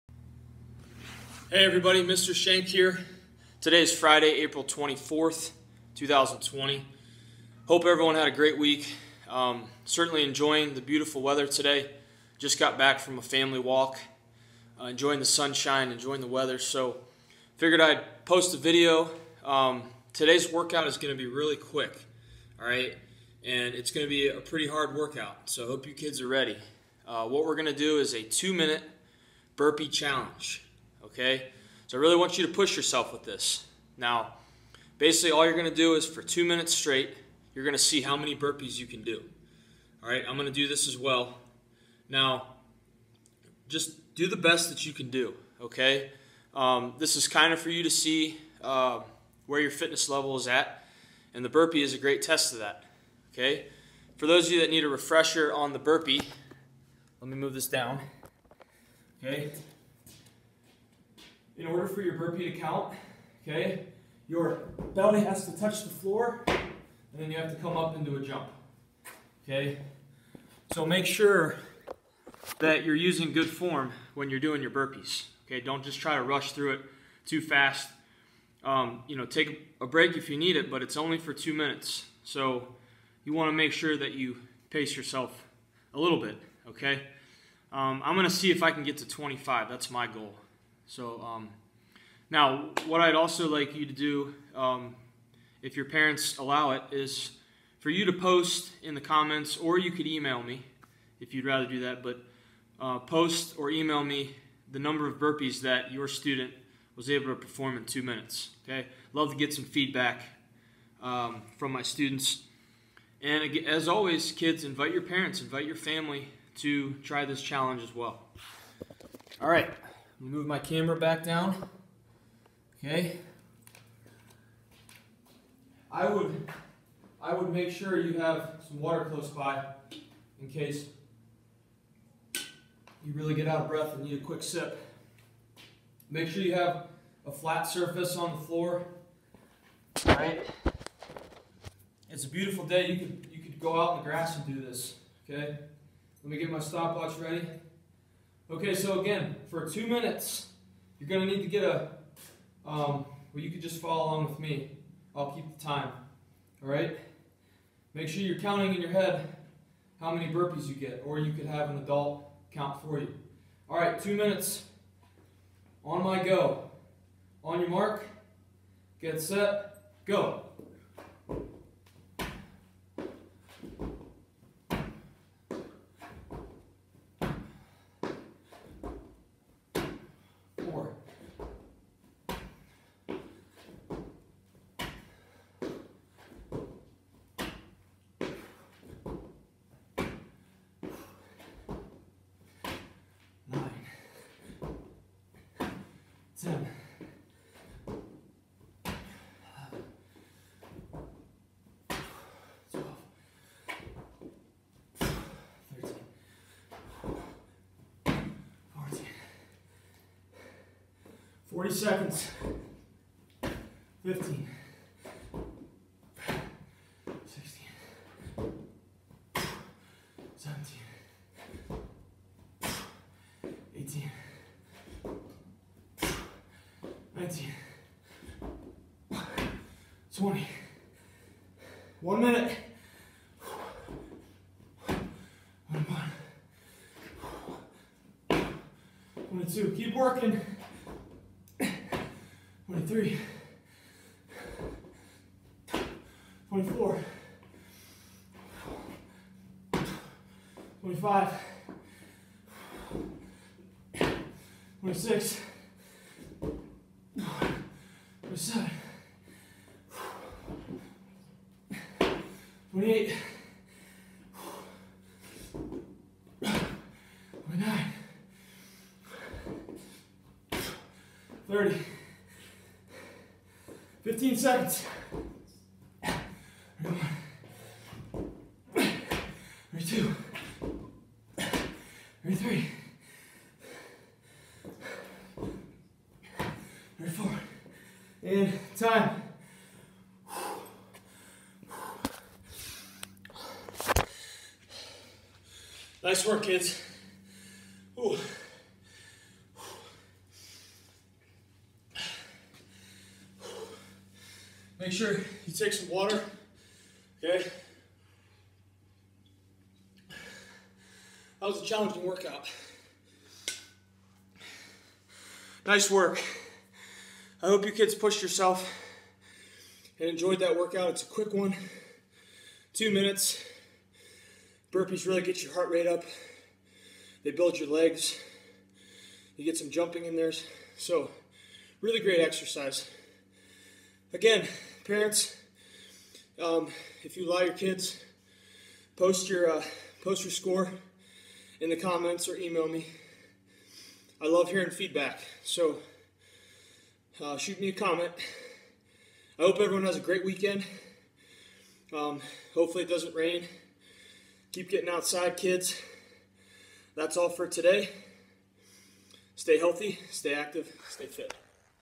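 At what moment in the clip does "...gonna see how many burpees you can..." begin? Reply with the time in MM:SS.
00:37.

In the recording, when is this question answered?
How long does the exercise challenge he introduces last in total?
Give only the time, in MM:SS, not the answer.
00:28.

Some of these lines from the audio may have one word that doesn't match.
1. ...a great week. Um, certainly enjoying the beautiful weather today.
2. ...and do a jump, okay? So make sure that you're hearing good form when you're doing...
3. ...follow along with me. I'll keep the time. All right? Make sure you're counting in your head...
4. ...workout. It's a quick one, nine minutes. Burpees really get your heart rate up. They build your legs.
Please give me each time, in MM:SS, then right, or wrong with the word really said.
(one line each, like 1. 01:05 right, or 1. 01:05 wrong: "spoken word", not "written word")
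1. 00:08 right
2. 01:07 wrong: "using", not "hearing"
3. 02:33 right
4. 05:20 wrong: "two", not "nine".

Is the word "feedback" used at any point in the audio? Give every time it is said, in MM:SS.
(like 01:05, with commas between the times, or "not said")
01:49, 05:44.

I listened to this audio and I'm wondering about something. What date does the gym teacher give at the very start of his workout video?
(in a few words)
April 24th.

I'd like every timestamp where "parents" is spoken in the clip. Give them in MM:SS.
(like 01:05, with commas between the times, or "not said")
01:35, 01:55, 05:34.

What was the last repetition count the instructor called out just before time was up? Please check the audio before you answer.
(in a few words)
34.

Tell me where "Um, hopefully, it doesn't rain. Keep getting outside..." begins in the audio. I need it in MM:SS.
05:51.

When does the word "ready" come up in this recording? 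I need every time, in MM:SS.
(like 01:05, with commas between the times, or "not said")
00:26, 02:27.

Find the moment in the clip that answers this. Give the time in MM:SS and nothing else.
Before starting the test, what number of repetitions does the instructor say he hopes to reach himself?
01:29.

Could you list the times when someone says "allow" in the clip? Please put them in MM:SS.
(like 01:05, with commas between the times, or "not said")
01:36, 05:37.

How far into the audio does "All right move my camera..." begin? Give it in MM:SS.
01:59.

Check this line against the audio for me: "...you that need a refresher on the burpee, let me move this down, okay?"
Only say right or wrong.
right.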